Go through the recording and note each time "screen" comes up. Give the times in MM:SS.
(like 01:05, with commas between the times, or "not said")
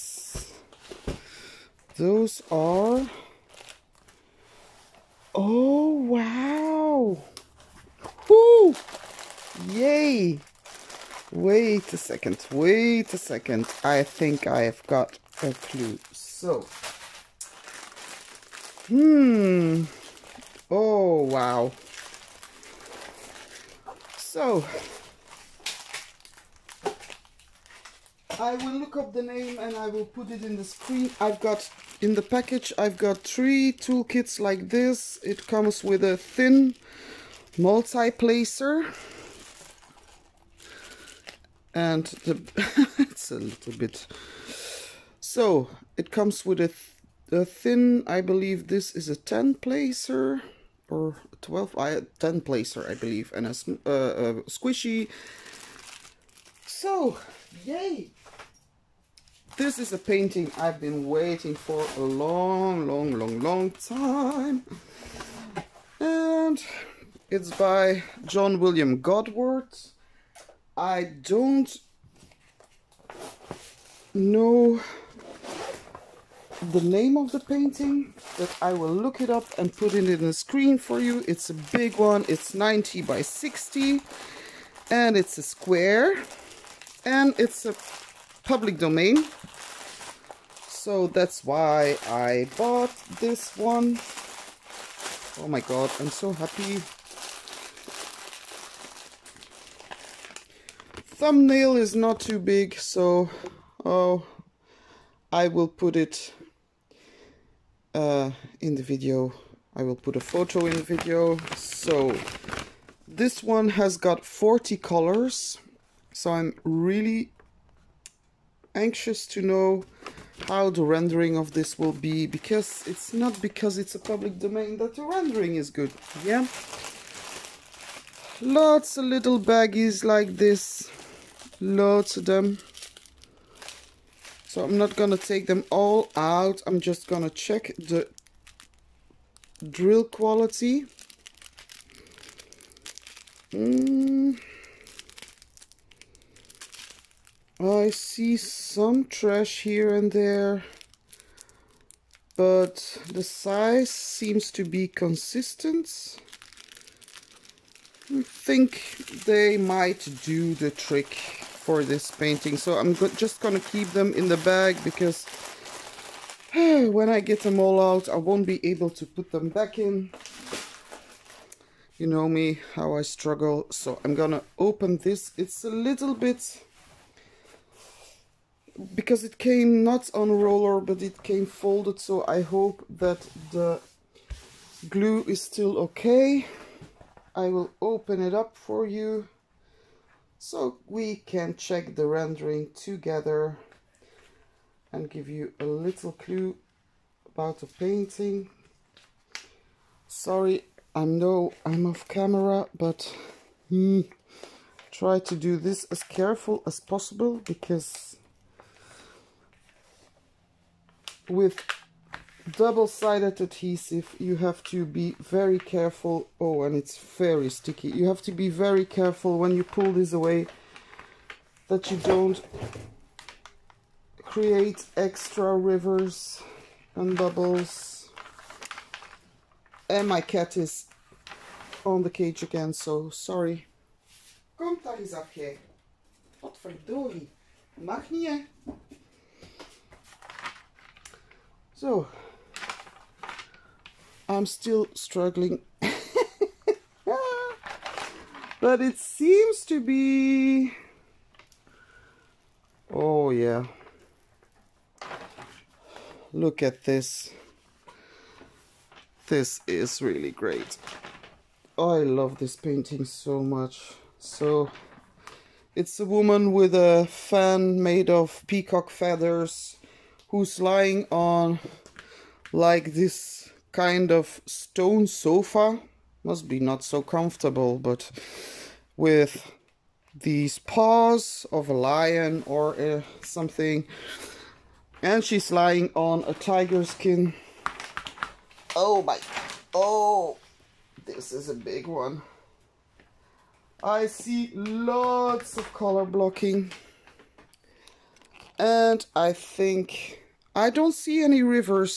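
00:30, 01:20.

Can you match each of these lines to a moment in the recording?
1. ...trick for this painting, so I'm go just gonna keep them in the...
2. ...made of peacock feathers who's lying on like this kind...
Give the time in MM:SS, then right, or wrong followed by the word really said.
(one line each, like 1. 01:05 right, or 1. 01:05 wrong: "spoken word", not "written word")
1. 02:40 right
2. 04:27 right.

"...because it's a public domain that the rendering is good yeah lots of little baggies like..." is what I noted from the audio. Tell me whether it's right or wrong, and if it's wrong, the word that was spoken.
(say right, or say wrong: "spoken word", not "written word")
right.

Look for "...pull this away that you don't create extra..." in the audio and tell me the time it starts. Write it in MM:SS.
03:39.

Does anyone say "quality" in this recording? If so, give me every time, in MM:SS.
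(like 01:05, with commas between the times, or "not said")
02:20.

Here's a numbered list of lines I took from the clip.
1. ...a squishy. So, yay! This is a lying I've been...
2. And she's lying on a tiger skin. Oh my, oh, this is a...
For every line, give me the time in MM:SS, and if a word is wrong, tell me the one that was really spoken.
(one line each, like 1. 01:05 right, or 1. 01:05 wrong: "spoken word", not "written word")
1. 00:54 wrong: "painting", not "lying"
2. 04:45 right.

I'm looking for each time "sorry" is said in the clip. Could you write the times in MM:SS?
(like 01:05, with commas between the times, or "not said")
03:20, 03:53.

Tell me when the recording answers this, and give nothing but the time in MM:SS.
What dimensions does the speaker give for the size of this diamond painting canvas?
01:22.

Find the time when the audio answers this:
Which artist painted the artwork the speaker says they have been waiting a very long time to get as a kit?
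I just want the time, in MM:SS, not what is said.
01:08.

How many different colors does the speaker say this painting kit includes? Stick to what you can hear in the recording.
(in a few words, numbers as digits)
40.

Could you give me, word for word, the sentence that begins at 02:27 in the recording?
I see some trash here and there, but the size seems to be consistent.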